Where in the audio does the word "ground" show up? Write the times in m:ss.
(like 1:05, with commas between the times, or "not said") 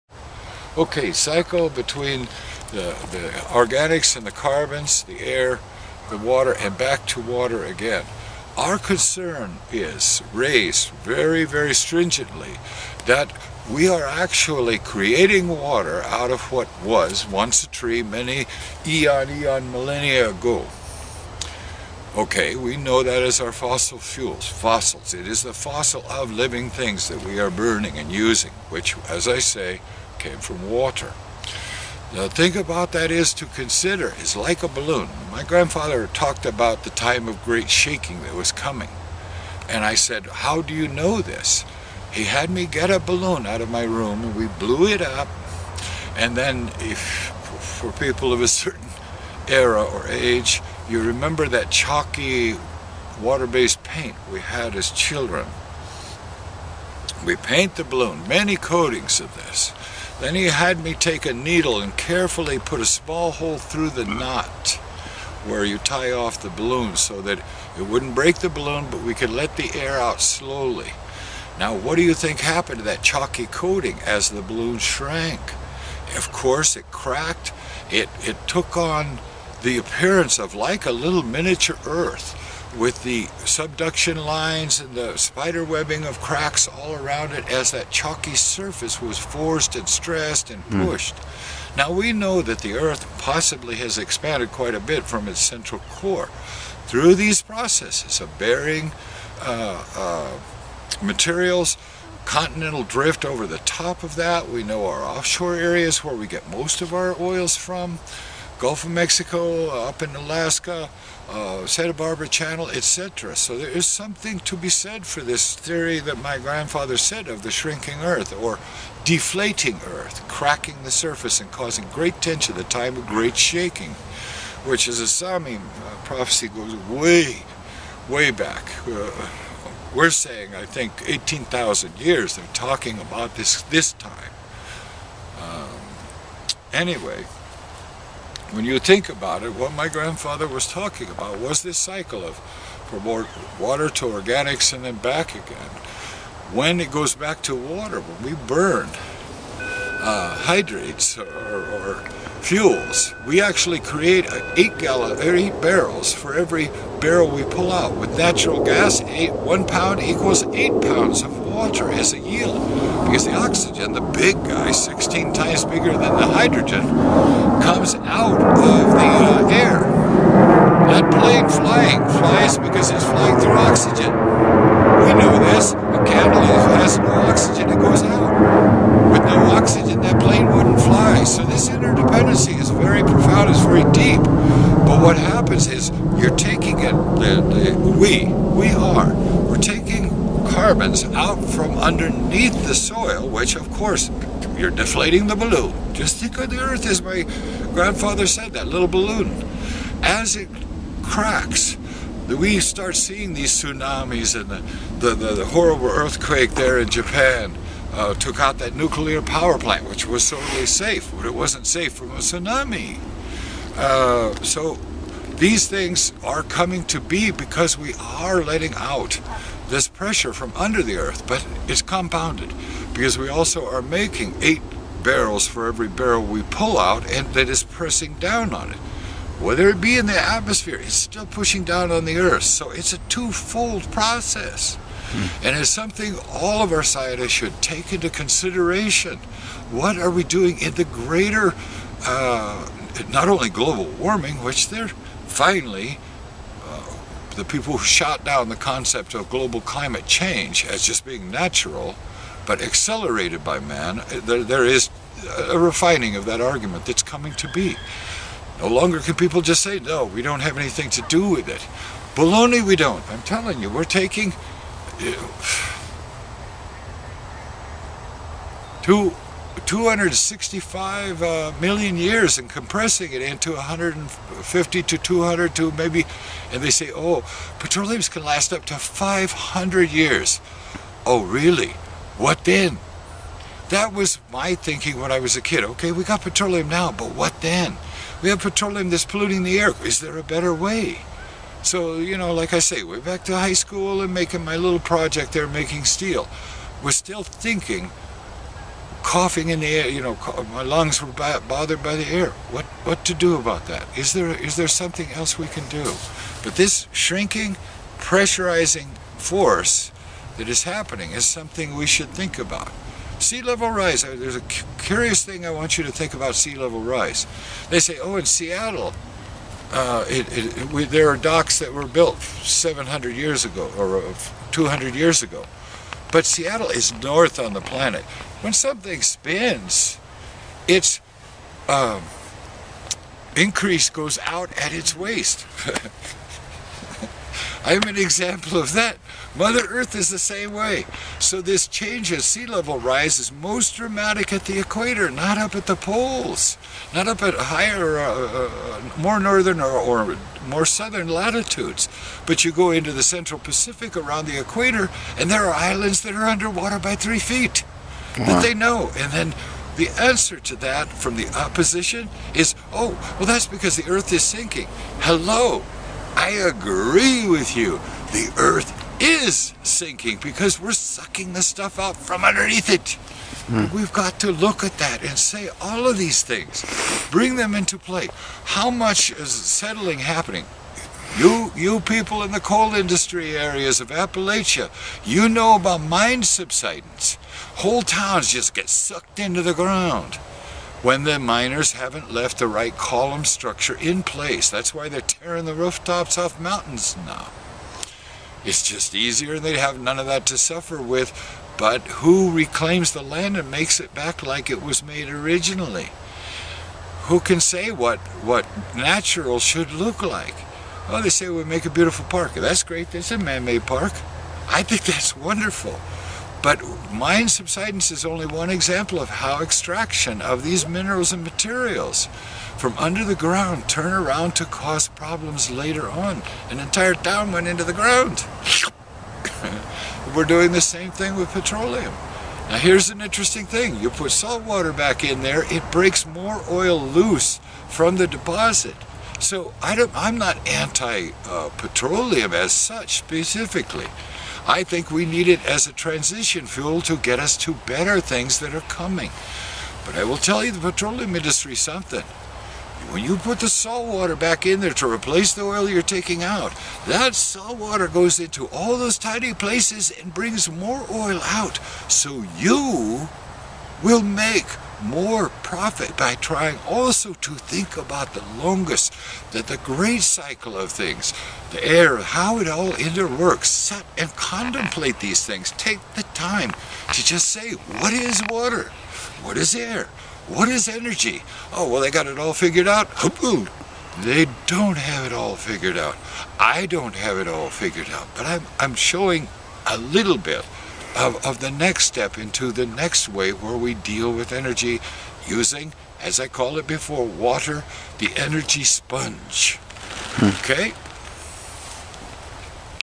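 6:29, 7:03, 7:07.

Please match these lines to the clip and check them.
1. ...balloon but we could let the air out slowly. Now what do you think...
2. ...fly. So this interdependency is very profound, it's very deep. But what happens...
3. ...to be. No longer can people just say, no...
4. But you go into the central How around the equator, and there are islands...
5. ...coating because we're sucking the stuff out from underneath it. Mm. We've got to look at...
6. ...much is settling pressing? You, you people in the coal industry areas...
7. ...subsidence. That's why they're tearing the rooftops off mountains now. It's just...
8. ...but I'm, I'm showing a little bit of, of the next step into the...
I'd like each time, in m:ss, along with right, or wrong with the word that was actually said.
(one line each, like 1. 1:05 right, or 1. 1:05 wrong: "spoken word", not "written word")
1. 1:08 right
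2. 3:00 right
3. 4:17 right
4. 5:52 wrong: "Pacific", not "How"
5. 6:09 wrong: "sinking", not "coating"
6. 6:18 wrong: "happening", not "pressing"
7. 6:34 wrong: "place", not "subsidence"
8. 8:08 right.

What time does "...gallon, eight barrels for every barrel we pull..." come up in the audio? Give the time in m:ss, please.
2:34.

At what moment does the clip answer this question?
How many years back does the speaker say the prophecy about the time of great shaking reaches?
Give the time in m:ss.
2:11.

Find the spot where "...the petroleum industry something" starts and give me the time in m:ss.
7:30.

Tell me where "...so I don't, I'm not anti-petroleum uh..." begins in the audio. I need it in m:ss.
7:19.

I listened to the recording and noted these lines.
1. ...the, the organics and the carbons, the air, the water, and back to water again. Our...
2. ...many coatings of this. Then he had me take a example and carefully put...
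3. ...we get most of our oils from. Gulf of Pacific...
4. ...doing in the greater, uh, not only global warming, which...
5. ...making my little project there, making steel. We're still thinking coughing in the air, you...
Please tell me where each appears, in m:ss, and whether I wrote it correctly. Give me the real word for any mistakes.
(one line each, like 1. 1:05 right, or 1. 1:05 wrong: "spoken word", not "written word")
1. 0:02 right
2. 0:58 wrong: "needle", not "example"
3. 1:46 wrong: "Mexico", not "Pacific"
4. 4:00 right
5. 4:54 right.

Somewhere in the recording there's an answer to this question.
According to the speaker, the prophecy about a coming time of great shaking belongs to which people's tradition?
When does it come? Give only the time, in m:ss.
2:05.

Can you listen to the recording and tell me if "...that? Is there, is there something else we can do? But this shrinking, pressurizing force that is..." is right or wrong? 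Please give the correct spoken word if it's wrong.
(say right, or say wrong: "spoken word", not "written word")
right.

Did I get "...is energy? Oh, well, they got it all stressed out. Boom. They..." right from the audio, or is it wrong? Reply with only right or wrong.
wrong.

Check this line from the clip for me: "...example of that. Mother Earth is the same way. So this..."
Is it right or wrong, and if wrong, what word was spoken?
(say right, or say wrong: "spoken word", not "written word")
right.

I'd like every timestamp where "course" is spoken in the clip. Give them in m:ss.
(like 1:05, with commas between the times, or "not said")
1:16, 3:13.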